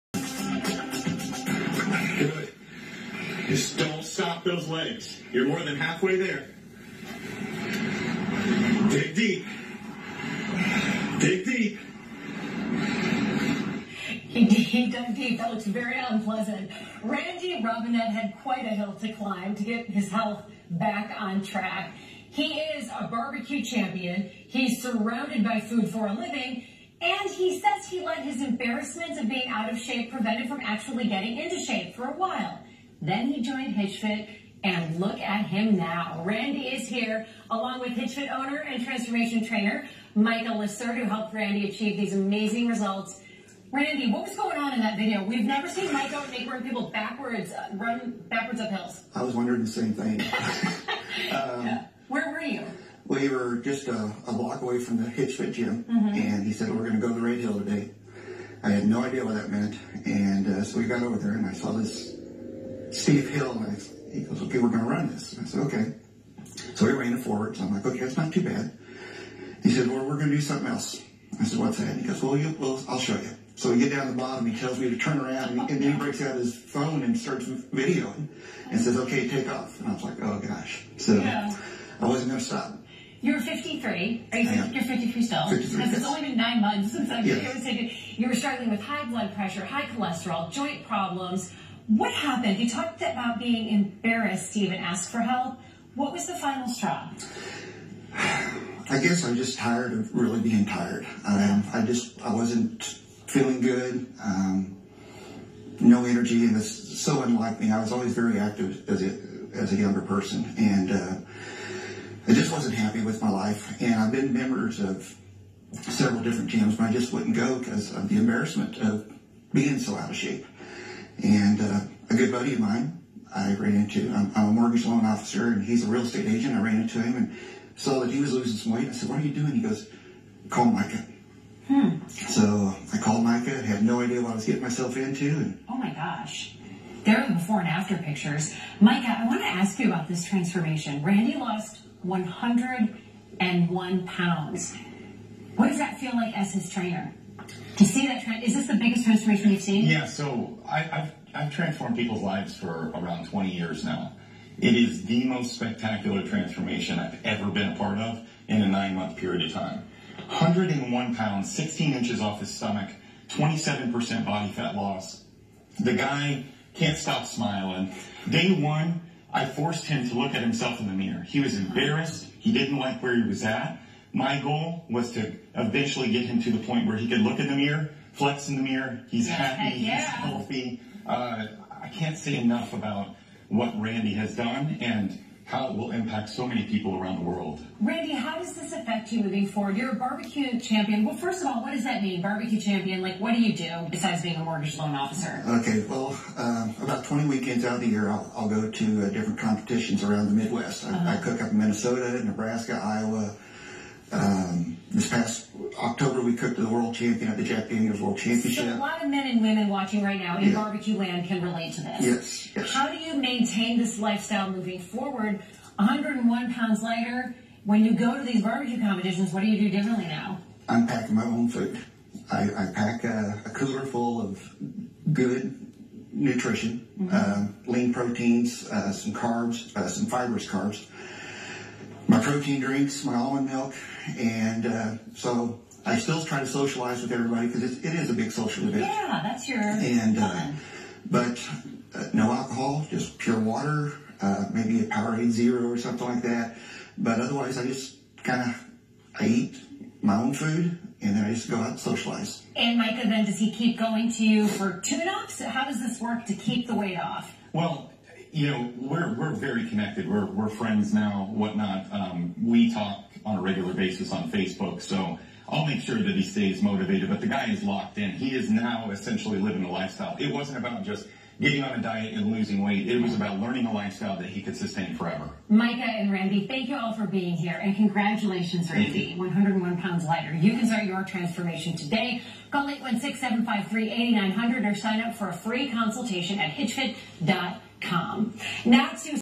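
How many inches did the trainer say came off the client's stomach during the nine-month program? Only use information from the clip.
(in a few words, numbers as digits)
16.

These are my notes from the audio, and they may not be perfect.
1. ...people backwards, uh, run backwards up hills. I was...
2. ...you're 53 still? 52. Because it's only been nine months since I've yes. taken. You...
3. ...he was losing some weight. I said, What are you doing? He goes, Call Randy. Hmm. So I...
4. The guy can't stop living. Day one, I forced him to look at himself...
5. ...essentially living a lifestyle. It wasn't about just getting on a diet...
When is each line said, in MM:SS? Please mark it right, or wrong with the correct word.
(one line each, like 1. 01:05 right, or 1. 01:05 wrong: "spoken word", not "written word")
1. 00:46 right
2. 01:24 wrong: "53", not "52"
3. 02:08 wrong: "Micah", not "Randy"
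4. 02:45 wrong: "smiling", not "living"
5. 04:28 right.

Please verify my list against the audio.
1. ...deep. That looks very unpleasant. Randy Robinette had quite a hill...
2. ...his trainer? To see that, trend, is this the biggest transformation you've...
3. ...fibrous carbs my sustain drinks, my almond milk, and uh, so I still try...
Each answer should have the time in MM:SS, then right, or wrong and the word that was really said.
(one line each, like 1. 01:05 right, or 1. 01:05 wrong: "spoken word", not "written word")
1. 00:15 right
2. 02:26 right
3. 03:50 wrong: "protein", not "sustain".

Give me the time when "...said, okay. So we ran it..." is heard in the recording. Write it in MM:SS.
01:05.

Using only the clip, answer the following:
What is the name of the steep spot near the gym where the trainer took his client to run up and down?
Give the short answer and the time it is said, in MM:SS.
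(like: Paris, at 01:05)
Red Hill, at 00:57.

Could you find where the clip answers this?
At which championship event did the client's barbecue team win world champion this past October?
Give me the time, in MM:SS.
03:27.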